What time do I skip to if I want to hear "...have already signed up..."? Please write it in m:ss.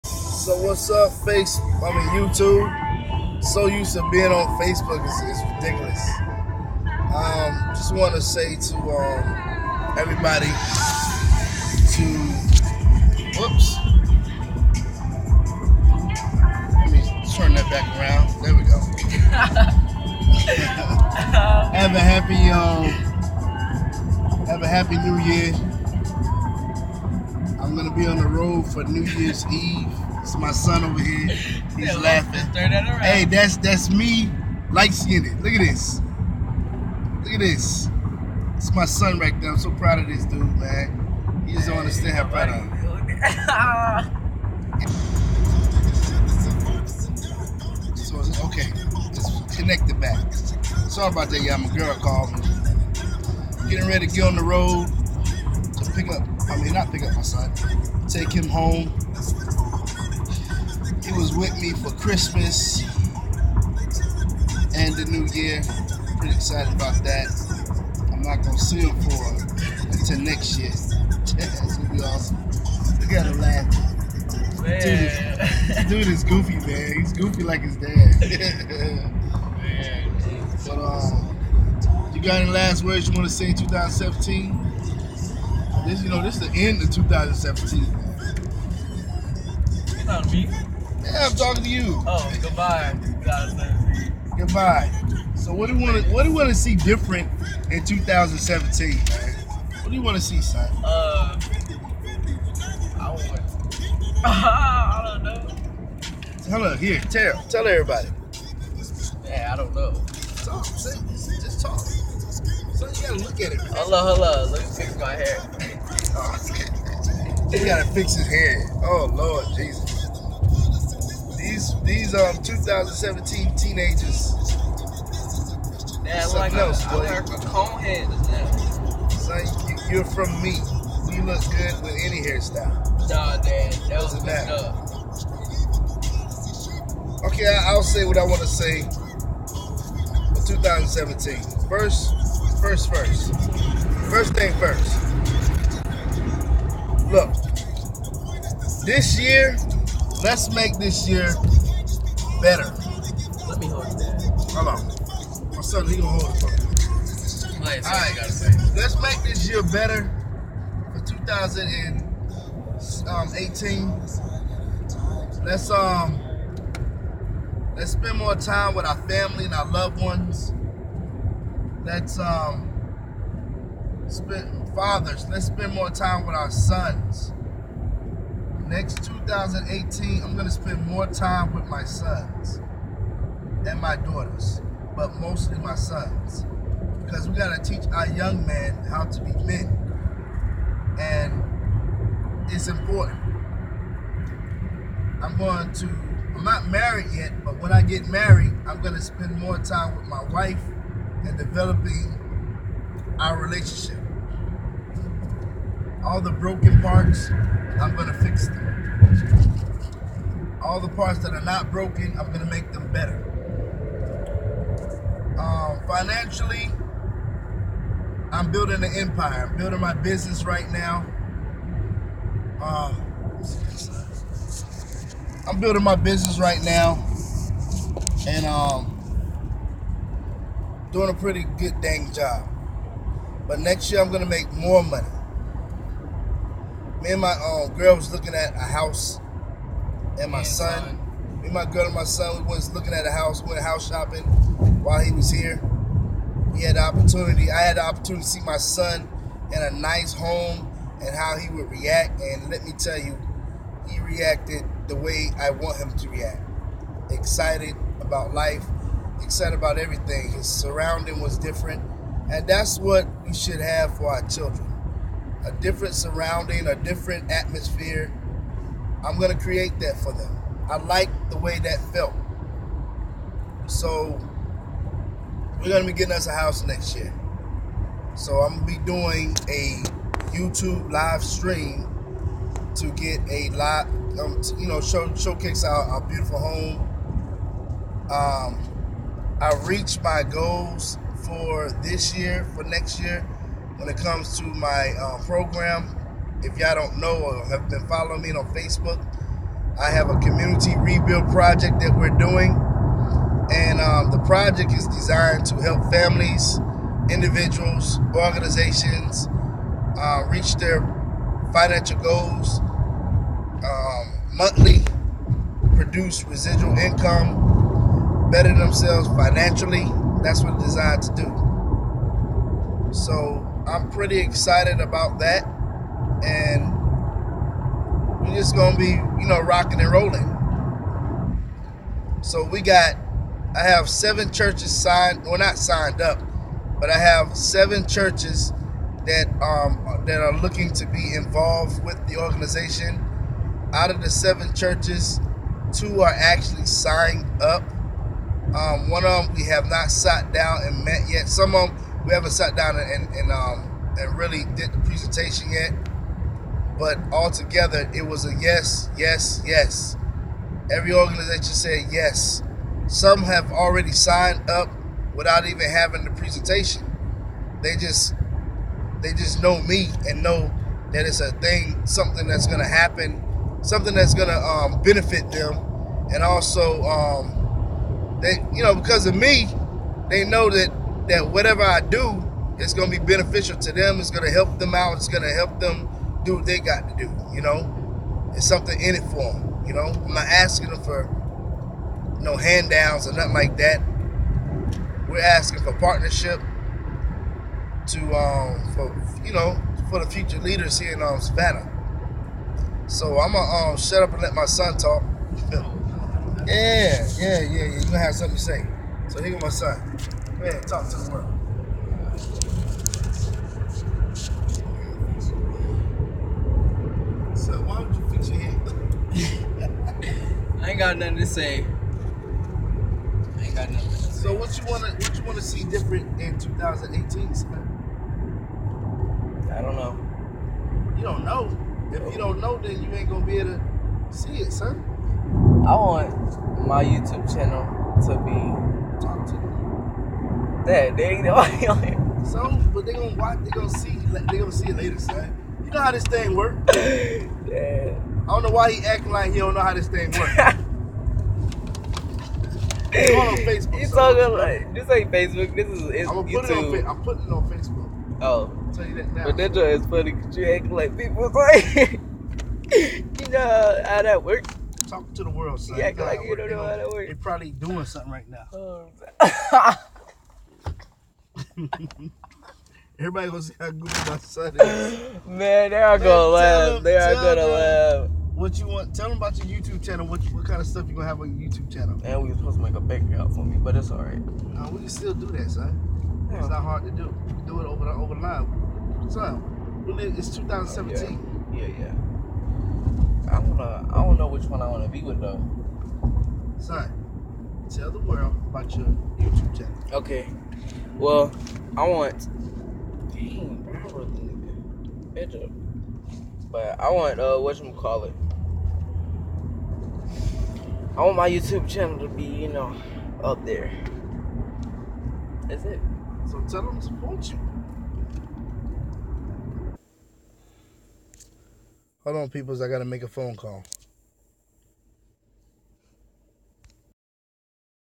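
6:03.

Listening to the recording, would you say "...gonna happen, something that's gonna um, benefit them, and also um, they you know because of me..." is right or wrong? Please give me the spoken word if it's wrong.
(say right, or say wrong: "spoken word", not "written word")
right.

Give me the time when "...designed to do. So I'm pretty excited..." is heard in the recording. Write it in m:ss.
5:20.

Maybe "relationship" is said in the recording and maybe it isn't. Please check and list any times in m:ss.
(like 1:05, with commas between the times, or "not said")
3:23.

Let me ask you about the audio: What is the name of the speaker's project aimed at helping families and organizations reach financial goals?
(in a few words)
community rebuild project.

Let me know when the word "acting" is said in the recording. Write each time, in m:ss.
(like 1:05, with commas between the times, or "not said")
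7:28, 7:40.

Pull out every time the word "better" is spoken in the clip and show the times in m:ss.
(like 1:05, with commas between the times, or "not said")
2:32, 2:39, 3:32, 5:18.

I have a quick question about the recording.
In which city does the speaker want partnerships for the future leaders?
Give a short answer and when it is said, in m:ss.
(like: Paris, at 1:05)
Savannah, at 6:41.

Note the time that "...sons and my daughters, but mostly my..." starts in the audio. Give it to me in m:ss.
3:01.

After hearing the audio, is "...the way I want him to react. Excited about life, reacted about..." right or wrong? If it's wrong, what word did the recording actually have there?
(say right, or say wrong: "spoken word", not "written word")
wrong: "excited", not "reacted".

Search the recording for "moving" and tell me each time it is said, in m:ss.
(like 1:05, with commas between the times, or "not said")
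not said.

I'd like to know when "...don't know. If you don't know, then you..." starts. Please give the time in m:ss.
7:11.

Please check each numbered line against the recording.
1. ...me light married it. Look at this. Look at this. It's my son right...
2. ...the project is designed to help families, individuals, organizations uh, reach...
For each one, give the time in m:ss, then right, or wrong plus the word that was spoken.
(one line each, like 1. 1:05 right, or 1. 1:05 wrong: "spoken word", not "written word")
1. 0:33 wrong: "skinned", not "married"
2. 5:04 right.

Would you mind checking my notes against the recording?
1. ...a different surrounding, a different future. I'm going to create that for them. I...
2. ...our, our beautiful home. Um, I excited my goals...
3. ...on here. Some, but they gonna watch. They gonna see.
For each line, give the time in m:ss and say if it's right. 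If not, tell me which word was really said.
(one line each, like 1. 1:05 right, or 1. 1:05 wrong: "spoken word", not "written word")
1. 4:25 wrong: "atmosphere", not "future"
2. 4:45 wrong: "reached", not "excited"
3. 7:21 right.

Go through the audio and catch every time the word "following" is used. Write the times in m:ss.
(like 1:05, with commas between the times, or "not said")
4:57.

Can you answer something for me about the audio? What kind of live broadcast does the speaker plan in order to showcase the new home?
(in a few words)
YouTube live stream.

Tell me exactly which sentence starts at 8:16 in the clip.
Son, tell the world about your YouTube channel.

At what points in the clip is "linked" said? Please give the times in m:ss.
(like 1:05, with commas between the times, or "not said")
not said.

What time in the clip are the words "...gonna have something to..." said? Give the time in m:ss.
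6:47.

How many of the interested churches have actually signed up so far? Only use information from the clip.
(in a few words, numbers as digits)
2.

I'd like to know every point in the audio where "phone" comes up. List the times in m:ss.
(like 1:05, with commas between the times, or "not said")
8:43.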